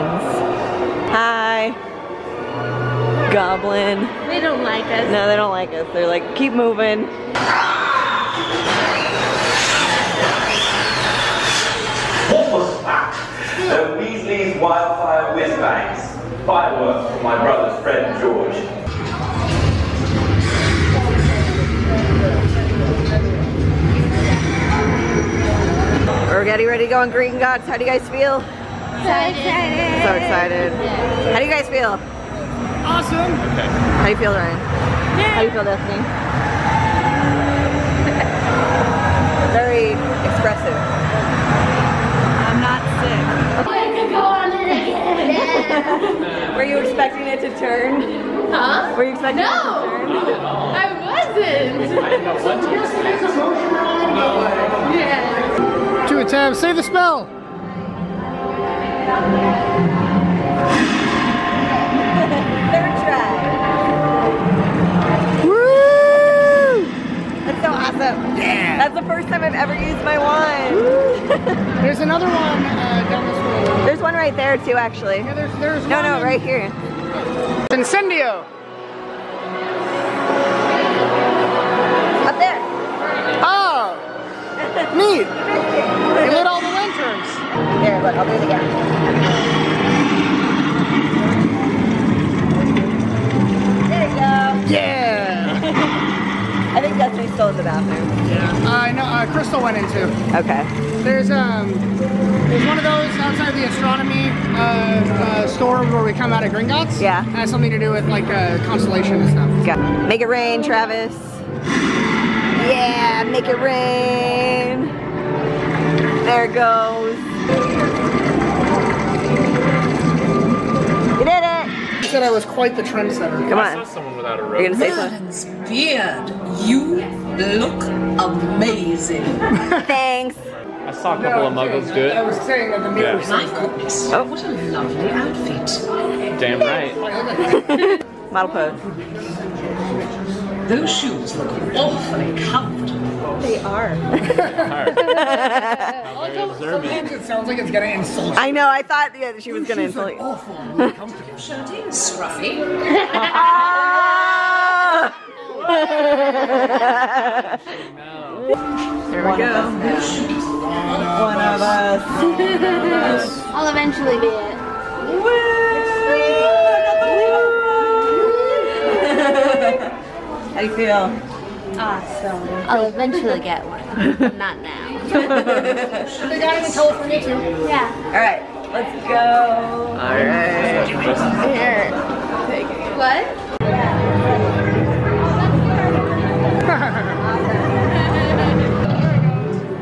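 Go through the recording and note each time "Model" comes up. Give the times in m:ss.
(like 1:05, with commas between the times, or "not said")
2:18.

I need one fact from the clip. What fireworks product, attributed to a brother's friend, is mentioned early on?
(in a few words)
Weasley's Wildfire Whiz Bangs.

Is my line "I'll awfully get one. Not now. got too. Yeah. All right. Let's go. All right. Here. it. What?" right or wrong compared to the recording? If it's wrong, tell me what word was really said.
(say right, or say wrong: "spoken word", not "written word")
wrong: "eventually", not "awfully".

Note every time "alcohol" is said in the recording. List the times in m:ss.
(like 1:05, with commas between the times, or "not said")
not said.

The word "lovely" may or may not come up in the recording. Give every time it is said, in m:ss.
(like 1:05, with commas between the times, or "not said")
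2:14.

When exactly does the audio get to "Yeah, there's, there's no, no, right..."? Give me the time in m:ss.
1:15.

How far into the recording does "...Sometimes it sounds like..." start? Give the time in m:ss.
2:26.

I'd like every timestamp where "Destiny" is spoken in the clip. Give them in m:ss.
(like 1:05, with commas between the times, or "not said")
0:35, 1:36.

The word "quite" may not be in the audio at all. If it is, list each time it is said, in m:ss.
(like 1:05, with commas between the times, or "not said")
2:02.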